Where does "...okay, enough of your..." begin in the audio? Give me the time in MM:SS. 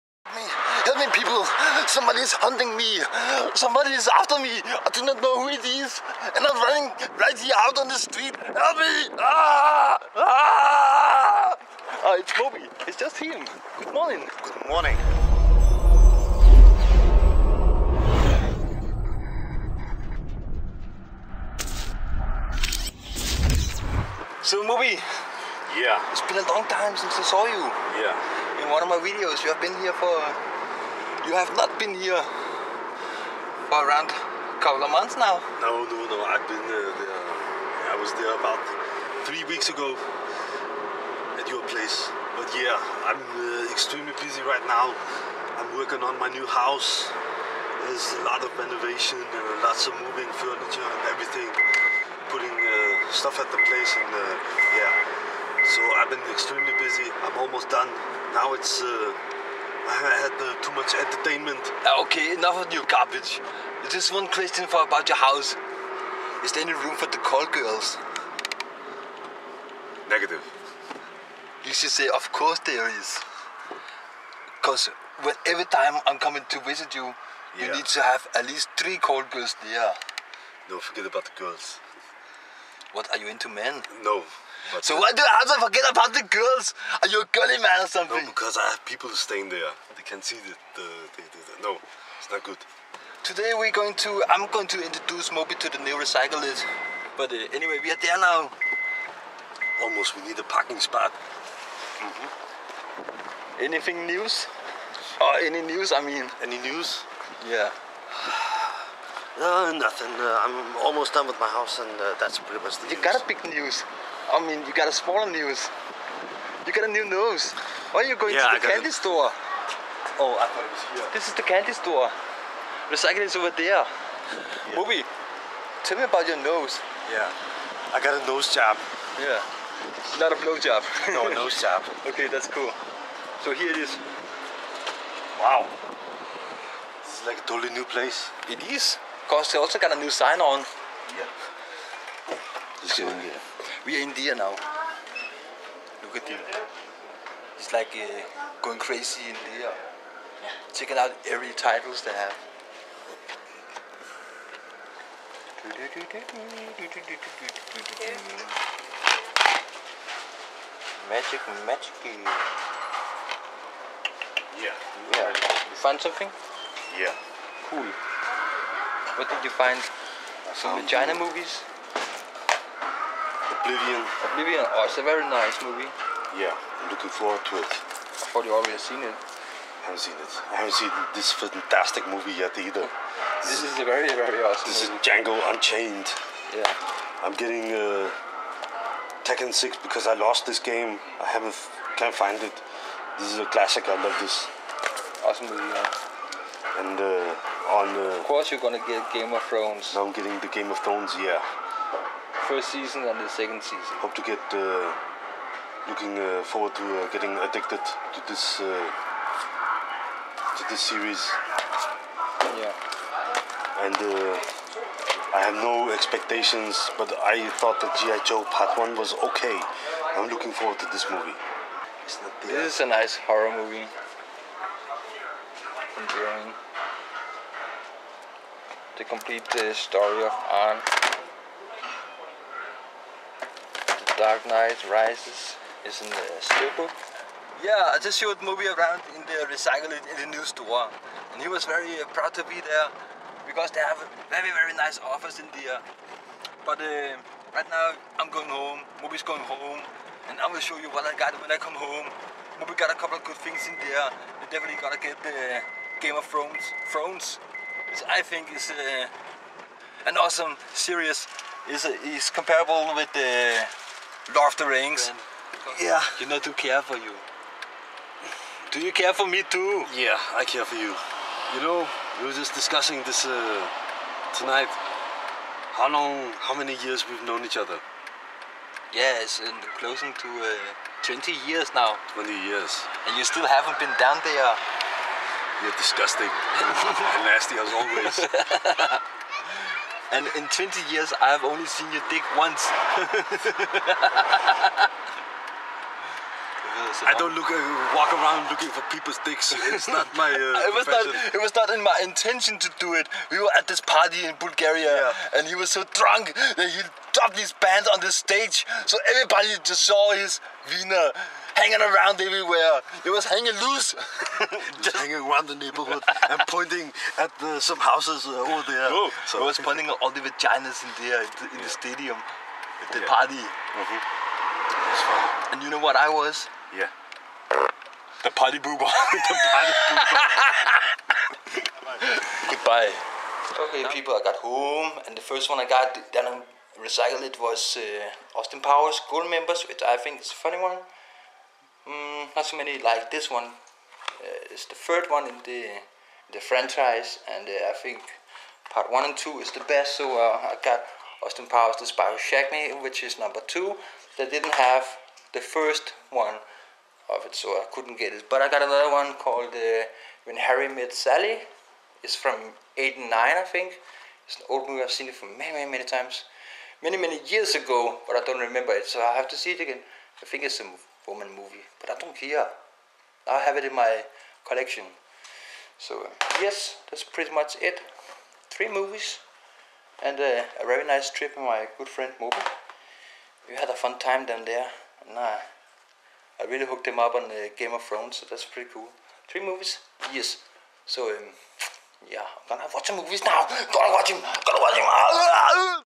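01:02.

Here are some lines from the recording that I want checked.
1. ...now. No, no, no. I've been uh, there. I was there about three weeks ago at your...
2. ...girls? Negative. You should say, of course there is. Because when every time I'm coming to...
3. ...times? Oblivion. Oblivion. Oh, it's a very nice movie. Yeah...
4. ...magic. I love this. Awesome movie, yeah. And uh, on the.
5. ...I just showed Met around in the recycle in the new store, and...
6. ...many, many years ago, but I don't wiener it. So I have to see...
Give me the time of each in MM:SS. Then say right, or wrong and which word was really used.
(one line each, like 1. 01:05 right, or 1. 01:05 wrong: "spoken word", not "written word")
1. 00:35 right
2. 01:07 right
3. 02:51 wrong: "movies", not "times"
4. 03:13 wrong: "classic", not "magic"
5. 03:57 wrong: "Moby", not "Met"
6. 06:06 wrong: "remember", not "wiener".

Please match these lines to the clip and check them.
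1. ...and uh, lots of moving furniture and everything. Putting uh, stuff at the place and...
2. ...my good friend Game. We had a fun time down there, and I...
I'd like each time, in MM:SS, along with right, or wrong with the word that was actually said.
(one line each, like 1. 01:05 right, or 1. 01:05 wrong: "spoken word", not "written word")
1. 00:49 right
2. 06:21 wrong: "Moby", not "Game".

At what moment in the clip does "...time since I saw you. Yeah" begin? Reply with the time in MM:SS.
00:26.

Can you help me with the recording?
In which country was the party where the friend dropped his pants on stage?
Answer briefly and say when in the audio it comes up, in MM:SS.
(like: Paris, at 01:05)
Bulgaria, at 05:04.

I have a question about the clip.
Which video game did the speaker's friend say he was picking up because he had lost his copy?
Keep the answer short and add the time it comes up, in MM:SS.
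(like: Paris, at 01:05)
Tekken 6, at 03:09.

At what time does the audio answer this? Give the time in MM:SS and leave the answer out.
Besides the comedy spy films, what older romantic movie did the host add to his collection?
06:00.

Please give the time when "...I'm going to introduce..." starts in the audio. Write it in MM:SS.
01:34.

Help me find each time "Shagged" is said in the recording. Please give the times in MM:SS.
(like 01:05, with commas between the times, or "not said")
05:52.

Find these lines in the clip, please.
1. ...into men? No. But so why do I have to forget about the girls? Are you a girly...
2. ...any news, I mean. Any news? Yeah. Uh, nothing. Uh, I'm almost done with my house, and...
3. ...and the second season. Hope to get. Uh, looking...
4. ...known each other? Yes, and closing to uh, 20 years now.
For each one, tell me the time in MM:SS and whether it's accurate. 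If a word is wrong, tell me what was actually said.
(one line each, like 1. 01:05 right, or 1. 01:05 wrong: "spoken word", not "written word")
1. 01:23 right
2. 01:45 right
3. 03:23 right
4. 04:37 right.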